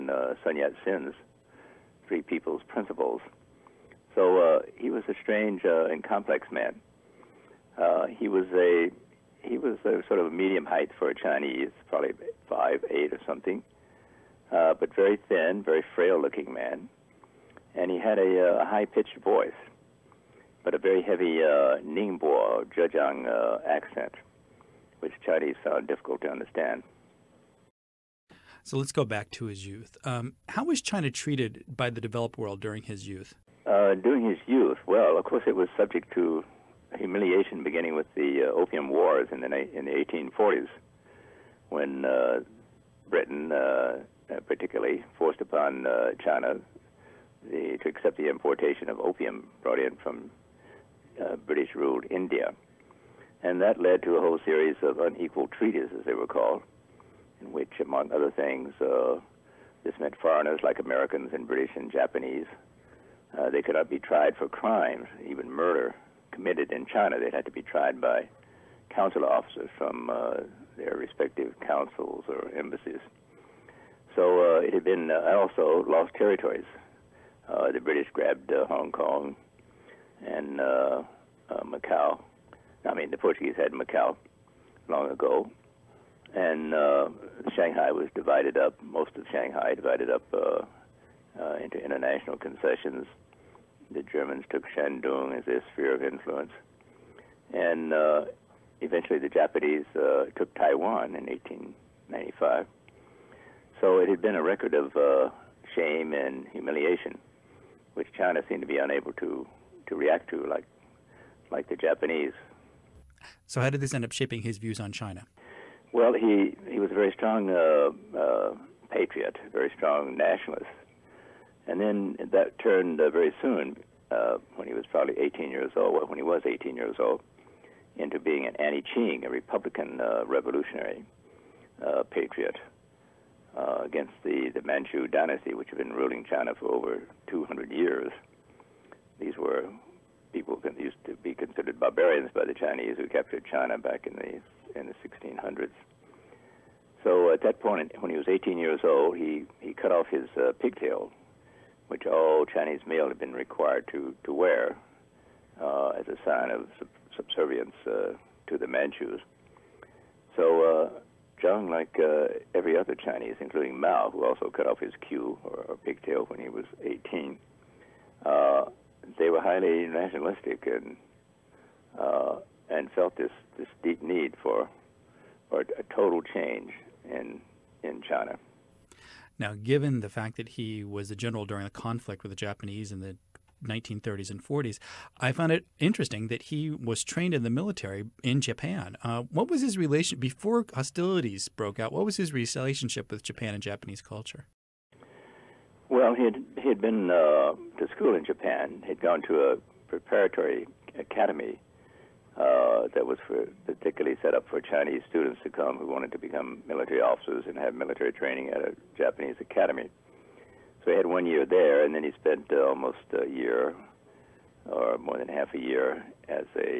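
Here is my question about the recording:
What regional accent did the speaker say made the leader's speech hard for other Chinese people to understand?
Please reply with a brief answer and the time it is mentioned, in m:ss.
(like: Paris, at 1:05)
Ningbo Zhejiang, at 0:21.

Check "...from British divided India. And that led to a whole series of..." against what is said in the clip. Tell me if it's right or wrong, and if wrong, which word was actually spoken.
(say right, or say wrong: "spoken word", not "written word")
wrong: "ruled", not "divided".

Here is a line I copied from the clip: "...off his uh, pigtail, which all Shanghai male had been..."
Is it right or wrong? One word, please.
wrong.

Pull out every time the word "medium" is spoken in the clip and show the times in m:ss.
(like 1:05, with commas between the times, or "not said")
0:10.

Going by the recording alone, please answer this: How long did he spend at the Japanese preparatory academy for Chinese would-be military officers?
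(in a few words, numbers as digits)
one year.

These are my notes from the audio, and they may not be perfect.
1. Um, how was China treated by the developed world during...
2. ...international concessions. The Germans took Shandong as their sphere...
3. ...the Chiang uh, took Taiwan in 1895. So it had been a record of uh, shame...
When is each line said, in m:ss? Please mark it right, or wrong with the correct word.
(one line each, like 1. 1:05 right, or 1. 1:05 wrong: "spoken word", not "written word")
1. 0:30 right
2. 1:31 right
3. 1:39 wrong: "Japanese", not "Chiang".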